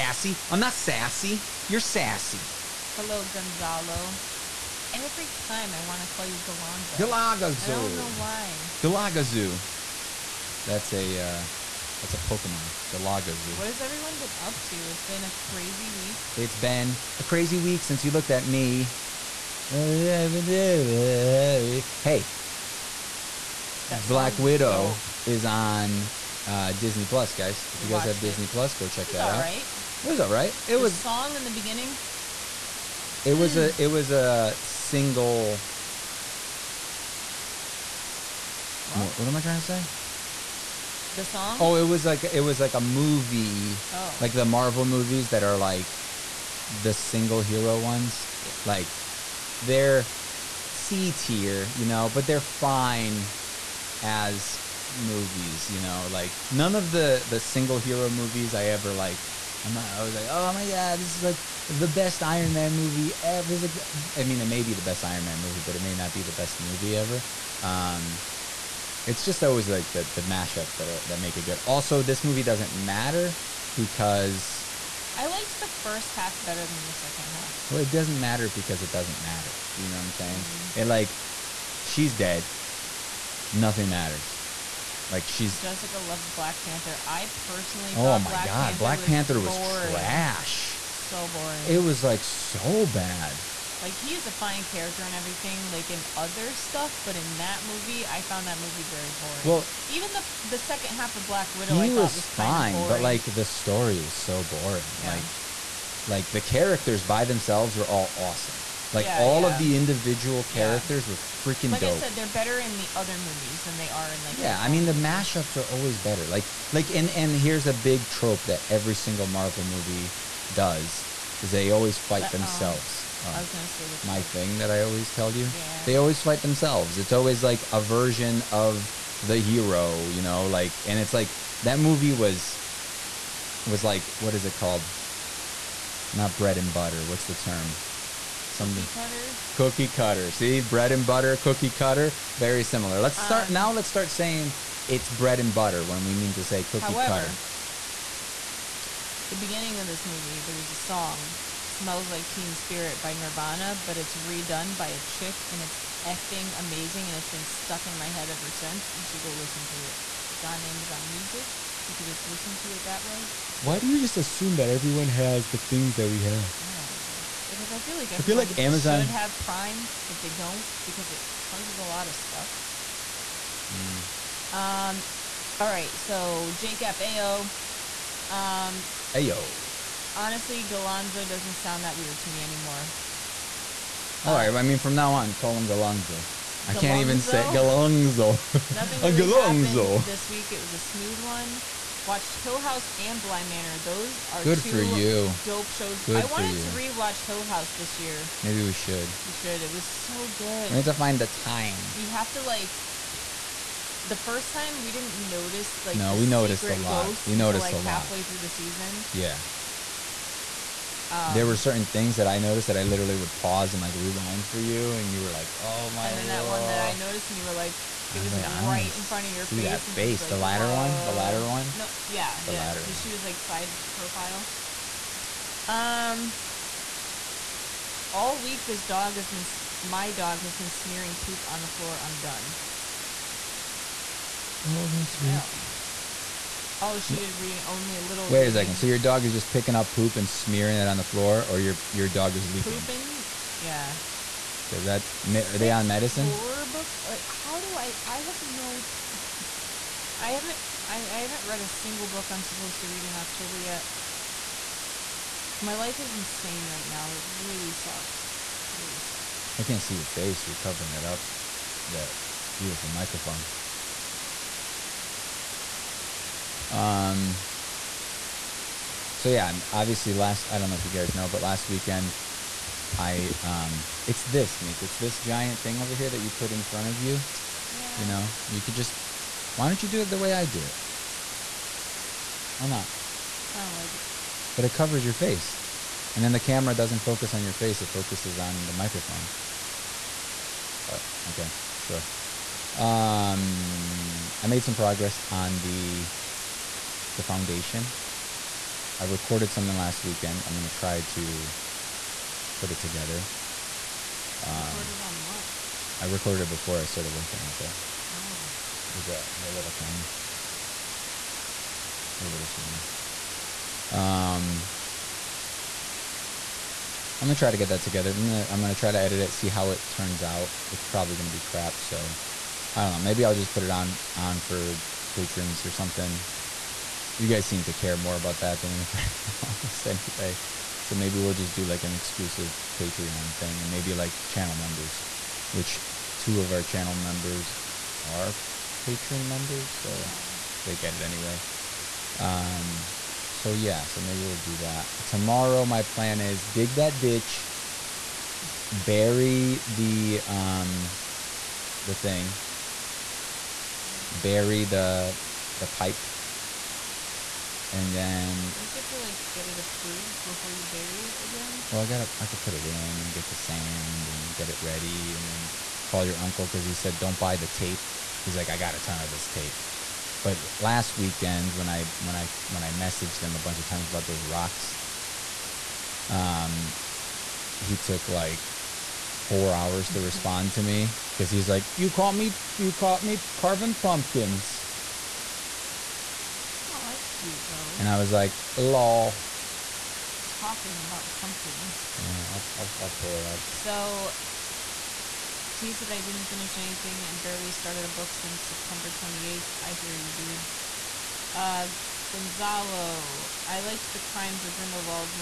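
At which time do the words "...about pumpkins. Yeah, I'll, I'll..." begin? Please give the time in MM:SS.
06:30.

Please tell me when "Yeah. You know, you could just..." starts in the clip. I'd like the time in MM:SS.
04:37.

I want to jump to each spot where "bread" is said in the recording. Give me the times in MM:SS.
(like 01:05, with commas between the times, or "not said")
02:16, 02:20, 02:25.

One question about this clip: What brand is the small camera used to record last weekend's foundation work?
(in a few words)
Sony.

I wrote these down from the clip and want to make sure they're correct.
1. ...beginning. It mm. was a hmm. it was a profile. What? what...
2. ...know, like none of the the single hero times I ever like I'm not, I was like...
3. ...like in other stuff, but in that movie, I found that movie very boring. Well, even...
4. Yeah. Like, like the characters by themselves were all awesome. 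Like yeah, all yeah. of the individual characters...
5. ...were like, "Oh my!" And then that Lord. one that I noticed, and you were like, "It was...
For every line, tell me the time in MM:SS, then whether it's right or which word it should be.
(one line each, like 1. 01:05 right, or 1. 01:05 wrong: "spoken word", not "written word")
1. 00:31 wrong: "single", not "profile"
2. 00:55 wrong: "movies", not "times"
3. 01:35 right
4. 01:44 right
5. 03:35 right.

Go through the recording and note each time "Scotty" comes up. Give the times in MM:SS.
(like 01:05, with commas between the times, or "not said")
not said.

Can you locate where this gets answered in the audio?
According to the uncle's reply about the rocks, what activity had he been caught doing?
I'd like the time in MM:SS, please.
06:23.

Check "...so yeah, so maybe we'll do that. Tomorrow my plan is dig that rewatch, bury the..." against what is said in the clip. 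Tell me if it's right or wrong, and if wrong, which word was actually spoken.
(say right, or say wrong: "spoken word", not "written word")
wrong: "ditch", not "rewatch".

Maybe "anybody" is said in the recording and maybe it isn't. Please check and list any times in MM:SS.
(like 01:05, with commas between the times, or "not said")
05:28.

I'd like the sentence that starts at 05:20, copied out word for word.
It's probably gonna be crap, so I don't know.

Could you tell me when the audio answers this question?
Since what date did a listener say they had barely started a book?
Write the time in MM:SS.
06:38.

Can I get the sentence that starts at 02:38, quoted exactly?
You should go listen to it.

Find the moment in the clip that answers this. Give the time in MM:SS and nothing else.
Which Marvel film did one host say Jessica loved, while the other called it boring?
01:26.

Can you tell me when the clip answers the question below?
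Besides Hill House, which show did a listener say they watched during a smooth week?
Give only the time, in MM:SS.
03:13.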